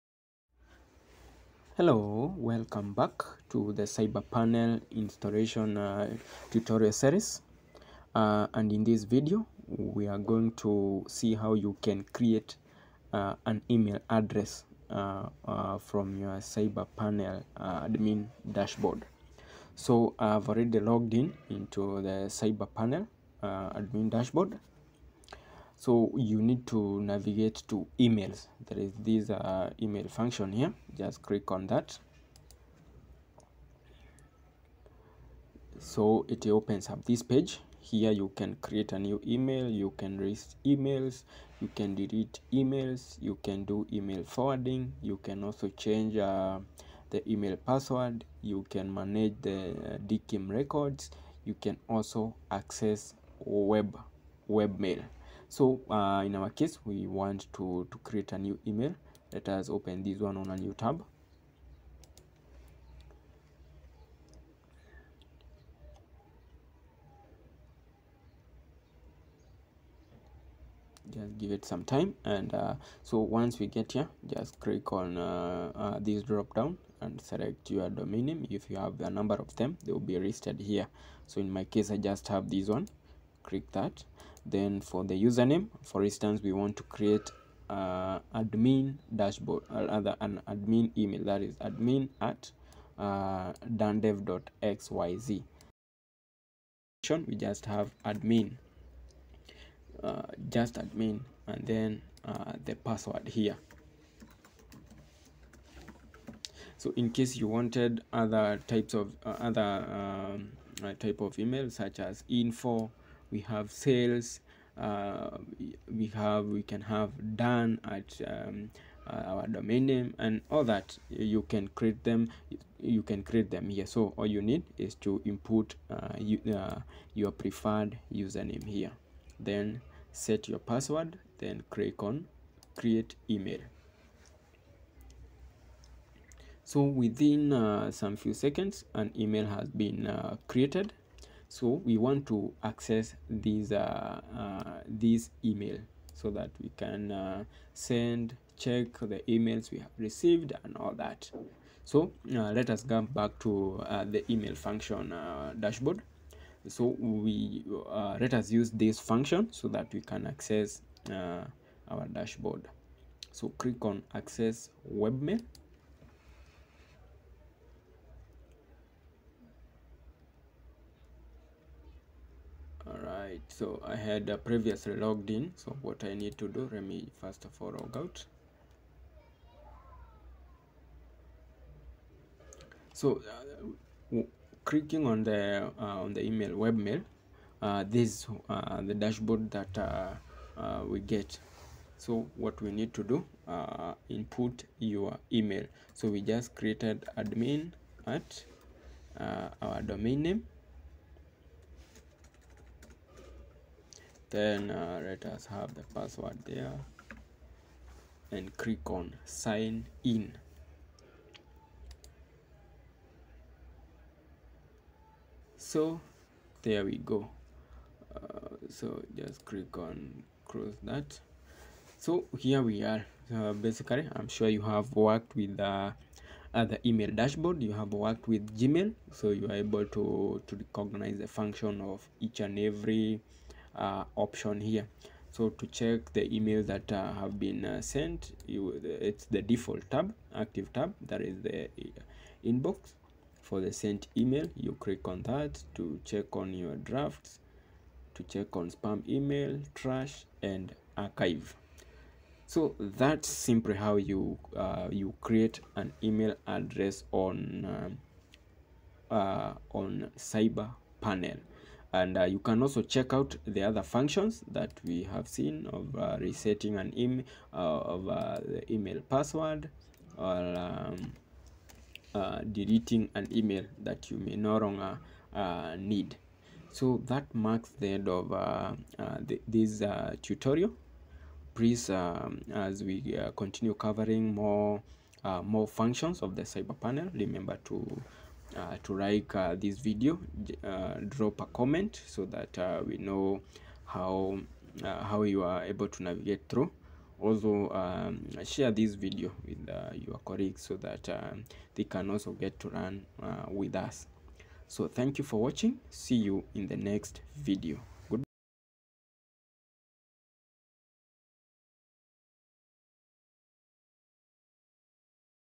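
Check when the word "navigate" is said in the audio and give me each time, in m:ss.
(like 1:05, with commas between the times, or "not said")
0:27, 4:56.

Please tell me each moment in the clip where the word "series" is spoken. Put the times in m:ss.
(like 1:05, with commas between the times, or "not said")
0:06.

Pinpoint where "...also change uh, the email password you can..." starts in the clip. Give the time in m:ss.
0:45.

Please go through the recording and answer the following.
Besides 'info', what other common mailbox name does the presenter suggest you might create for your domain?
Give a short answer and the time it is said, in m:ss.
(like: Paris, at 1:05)
sales, at 1:53.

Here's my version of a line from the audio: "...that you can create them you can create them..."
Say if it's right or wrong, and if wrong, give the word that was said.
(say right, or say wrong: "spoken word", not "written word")
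right.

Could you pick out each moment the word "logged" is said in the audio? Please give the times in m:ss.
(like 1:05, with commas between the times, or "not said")
0:20, 2:54.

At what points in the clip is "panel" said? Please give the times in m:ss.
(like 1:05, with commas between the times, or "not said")
0:04, 0:16, 0:22, 4:20, 4:46.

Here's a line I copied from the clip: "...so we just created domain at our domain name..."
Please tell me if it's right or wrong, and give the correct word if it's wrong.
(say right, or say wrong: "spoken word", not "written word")
wrong: "admin", not "domain".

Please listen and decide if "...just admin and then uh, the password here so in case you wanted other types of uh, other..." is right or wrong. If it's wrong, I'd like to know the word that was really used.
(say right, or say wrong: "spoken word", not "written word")
right.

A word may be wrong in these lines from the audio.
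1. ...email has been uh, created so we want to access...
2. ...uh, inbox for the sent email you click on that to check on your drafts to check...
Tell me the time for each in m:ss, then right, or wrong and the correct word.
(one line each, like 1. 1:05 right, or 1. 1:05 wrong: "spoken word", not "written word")
1. 2:19 right
2. 4:01 right.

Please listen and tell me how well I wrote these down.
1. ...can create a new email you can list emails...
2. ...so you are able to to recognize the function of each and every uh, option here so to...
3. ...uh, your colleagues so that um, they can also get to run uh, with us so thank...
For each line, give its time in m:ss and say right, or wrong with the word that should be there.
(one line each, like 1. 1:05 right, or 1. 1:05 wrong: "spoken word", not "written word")
1. 0:38 right
2. 3:49 right
3. 4:59 right.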